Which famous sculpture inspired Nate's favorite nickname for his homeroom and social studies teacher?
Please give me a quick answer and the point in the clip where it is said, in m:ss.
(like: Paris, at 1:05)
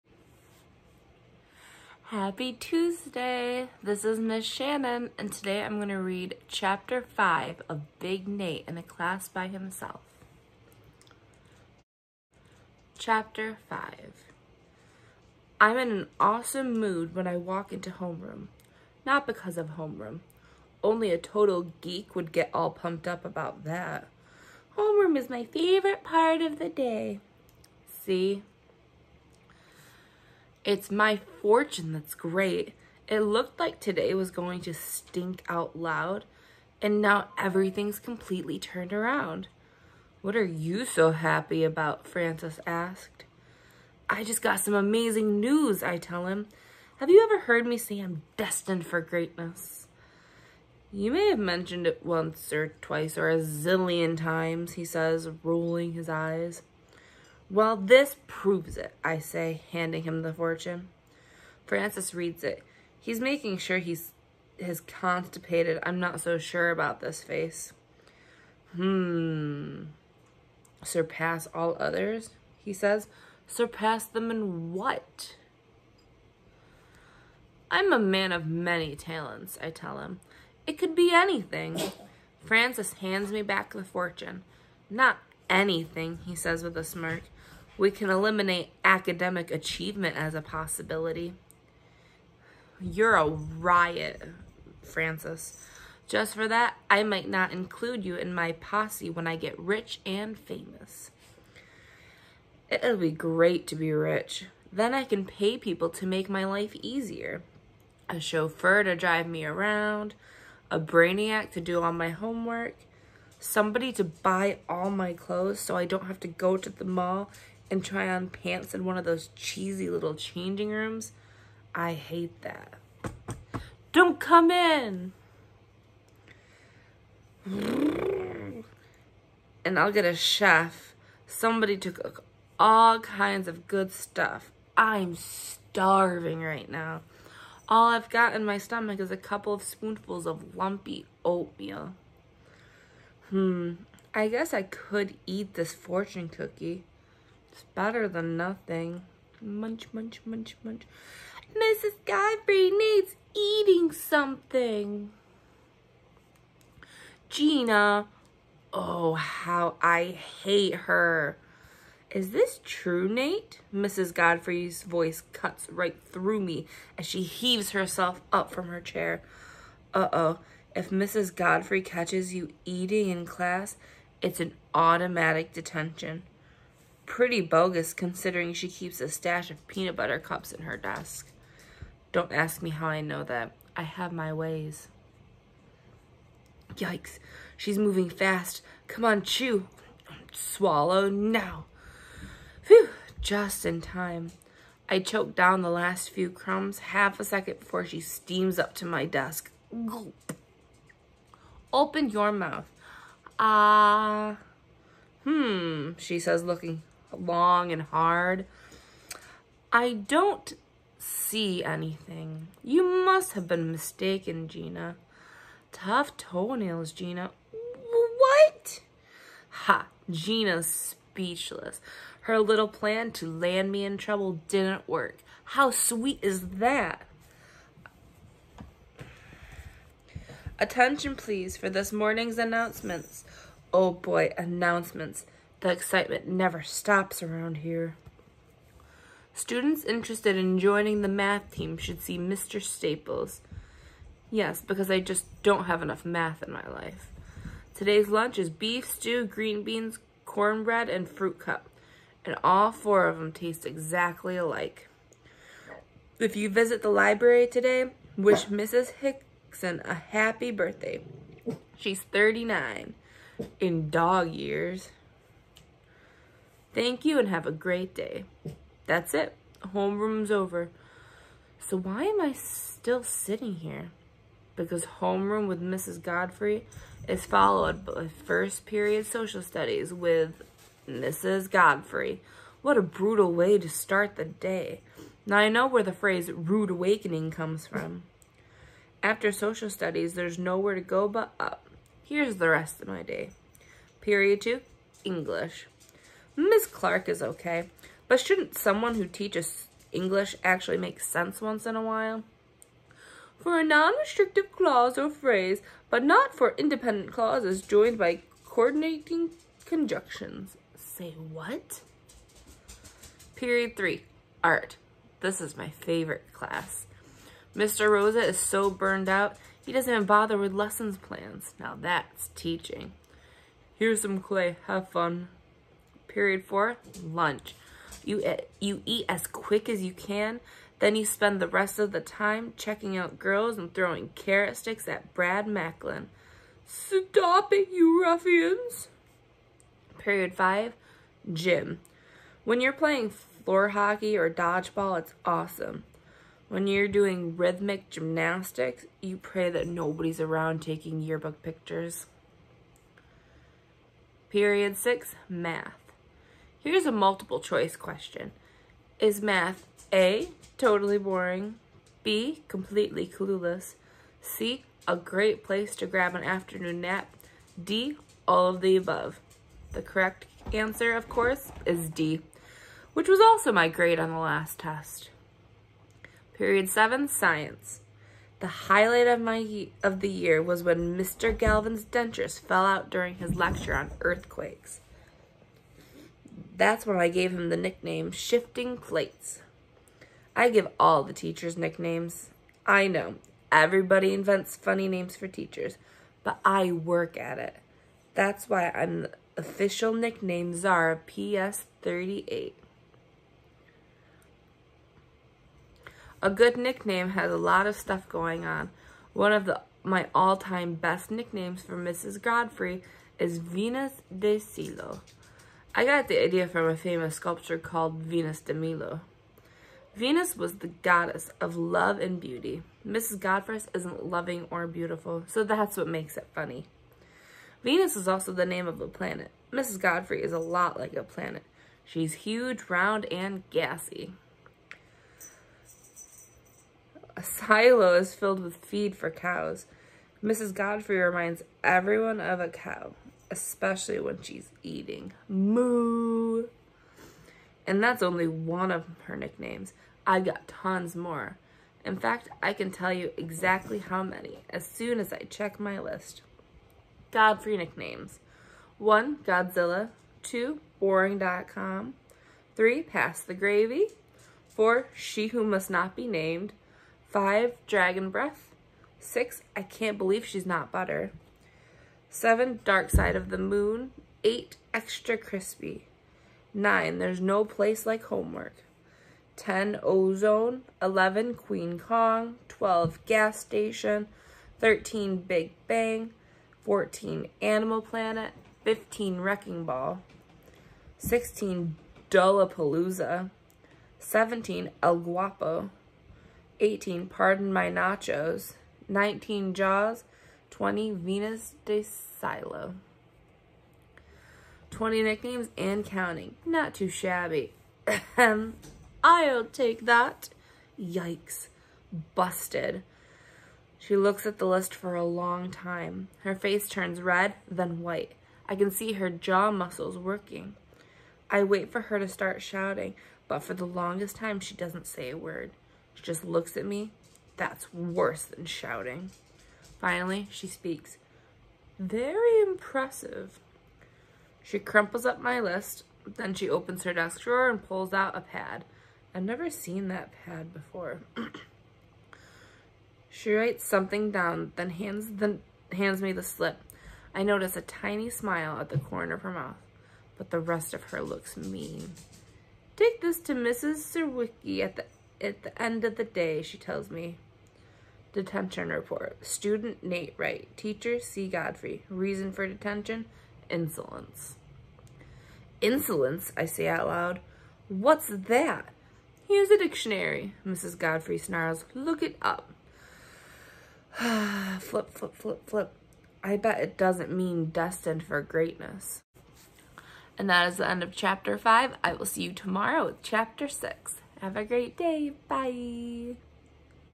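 Venus de Milo, at 6:58.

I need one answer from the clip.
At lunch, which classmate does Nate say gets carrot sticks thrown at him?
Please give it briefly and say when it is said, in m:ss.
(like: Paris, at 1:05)
Brad Macklin, at 5:35.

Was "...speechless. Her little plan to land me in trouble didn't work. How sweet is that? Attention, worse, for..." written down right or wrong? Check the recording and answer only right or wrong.
wrong.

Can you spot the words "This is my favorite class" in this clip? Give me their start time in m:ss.
5:15.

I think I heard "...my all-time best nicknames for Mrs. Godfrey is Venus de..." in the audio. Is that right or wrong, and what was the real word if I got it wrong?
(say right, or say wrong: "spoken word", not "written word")
right.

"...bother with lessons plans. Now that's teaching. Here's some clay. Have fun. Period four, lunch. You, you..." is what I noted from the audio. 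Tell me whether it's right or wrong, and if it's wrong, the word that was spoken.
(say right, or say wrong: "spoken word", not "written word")
right.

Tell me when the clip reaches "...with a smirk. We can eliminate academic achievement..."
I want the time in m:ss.
1:26.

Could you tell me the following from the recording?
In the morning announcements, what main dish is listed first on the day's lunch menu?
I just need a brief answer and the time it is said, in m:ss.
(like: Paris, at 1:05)
Beef stew, at 4:08.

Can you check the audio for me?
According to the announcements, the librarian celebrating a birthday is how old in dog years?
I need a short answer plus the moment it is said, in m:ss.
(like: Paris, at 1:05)
39, at 4:22.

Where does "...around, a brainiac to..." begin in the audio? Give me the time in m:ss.
1:49.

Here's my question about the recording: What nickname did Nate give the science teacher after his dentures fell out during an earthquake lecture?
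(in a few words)
Shifting Plates.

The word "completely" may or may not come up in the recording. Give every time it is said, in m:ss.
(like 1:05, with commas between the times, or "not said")
0:37, 6:02.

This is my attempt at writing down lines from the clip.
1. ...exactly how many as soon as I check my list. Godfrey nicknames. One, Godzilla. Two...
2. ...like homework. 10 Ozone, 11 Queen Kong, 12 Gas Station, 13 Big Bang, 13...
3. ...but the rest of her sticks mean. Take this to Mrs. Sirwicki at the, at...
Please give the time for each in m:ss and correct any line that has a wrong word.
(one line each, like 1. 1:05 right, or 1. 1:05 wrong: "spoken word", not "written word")
1. 7:33 right
2. 7:57 wrong: "14", not "13"
3. 9:10 wrong: "looks", not "sticks".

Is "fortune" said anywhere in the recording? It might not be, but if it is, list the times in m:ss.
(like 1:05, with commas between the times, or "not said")
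0:31, 1:00, 1:23, 2:25.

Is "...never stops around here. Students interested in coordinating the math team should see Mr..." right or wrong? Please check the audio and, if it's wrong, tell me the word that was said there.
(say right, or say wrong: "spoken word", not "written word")
wrong: "joining", not "coordinating".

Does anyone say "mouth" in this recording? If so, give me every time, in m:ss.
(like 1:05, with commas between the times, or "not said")
3:22, 9:09.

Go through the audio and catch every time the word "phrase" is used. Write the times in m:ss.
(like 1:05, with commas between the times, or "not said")
4:45, 5:05.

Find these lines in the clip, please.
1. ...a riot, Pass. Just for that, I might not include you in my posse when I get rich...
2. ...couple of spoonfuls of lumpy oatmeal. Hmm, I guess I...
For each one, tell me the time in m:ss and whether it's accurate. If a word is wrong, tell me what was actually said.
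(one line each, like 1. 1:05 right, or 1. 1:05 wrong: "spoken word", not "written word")
1. 1:33 wrong: "Francis", not "Pass"
2. 2:19 right.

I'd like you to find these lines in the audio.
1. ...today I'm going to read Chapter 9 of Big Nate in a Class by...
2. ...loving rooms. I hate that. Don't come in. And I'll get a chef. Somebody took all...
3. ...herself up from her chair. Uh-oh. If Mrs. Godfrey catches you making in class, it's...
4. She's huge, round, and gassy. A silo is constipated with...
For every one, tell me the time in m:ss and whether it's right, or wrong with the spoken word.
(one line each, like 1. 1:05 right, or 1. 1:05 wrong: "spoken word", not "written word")
1. 0:05 wrong: "5", not "9"
2. 2:00 wrong: "changing", not "loving"
3. 2:47 wrong: "eating", not "making"
4. 7:11 wrong: "filled", not "constipated".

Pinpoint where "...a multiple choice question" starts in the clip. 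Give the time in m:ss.
5:56.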